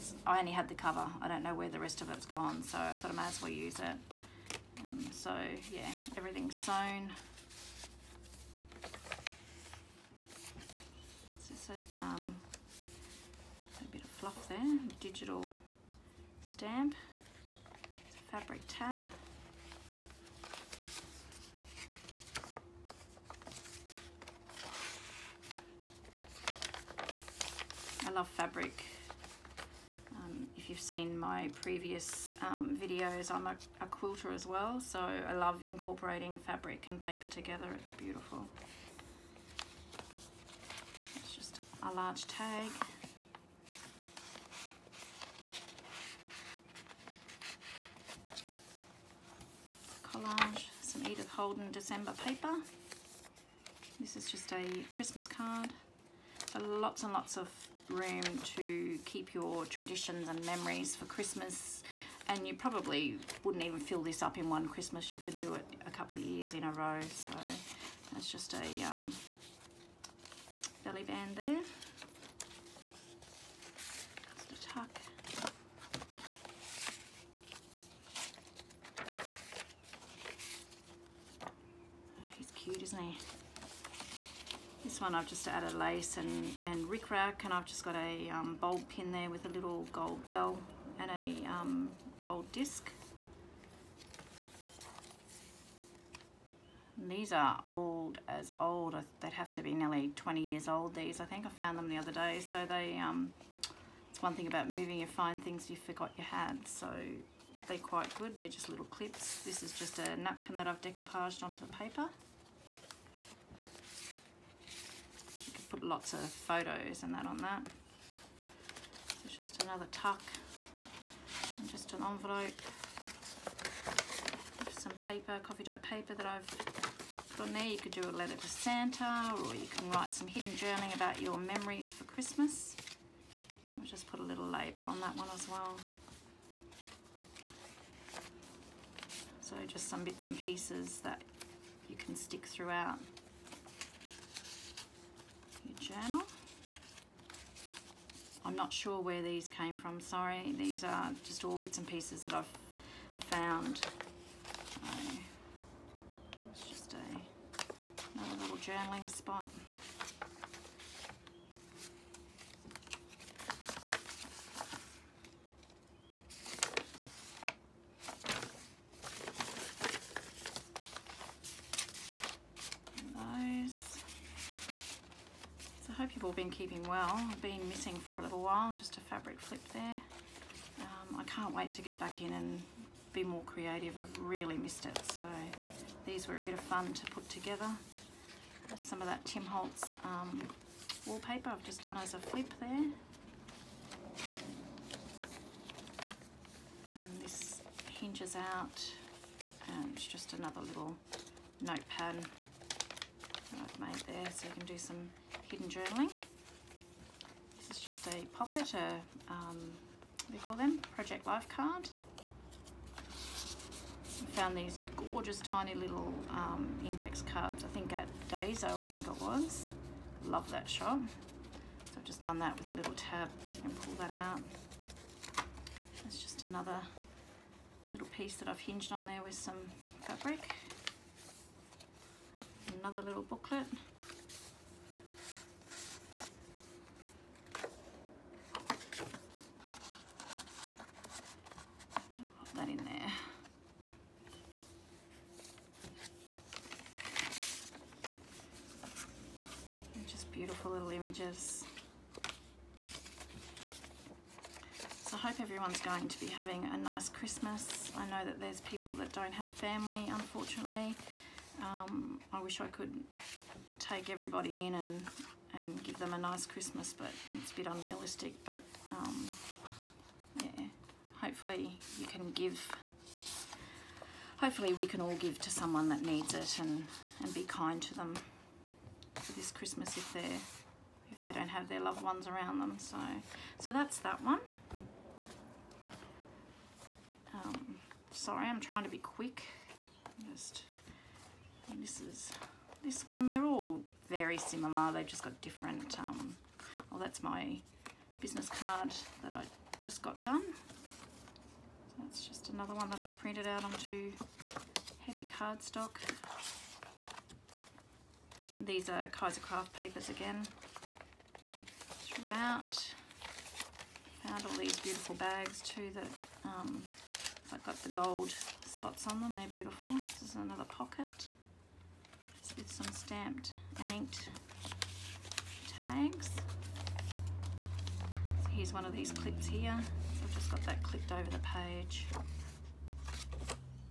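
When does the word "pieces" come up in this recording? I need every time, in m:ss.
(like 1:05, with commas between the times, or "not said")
2:20, 2:31, 3:48.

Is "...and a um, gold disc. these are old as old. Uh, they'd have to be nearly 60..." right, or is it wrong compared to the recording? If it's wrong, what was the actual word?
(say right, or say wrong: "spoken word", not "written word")
wrong: "20", not "60".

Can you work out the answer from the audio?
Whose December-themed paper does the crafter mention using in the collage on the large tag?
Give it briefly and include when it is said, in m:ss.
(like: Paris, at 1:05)
Edith Holden, at 0:51.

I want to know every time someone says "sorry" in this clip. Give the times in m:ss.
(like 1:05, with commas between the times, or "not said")
2:29, 4:48.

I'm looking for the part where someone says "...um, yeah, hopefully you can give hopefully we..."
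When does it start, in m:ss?
4:28.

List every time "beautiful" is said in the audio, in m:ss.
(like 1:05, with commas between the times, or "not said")
0:37, 5:14, 5:19.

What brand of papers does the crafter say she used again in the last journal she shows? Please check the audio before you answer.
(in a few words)
Kaiser Craft.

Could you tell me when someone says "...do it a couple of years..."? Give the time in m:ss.
1:05.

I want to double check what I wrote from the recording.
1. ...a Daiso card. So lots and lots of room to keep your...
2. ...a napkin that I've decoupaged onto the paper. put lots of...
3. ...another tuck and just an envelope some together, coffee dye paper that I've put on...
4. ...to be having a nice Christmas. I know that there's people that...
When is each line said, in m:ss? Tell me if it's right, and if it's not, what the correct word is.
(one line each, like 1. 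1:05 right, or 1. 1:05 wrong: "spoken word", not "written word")
1. 0:54 wrong: "Christmas", not "Daiso"
2. 1:49 right
3. 1:59 wrong: "paper", not "together"
4. 4:16 right.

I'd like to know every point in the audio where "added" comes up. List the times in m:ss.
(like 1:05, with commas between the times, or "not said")
1:25.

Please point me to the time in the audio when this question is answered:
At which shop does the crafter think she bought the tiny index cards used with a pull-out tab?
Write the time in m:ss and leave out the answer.
3:38.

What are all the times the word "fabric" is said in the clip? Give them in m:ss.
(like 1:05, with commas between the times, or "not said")
0:18, 0:28, 0:36, 2:59, 3:50.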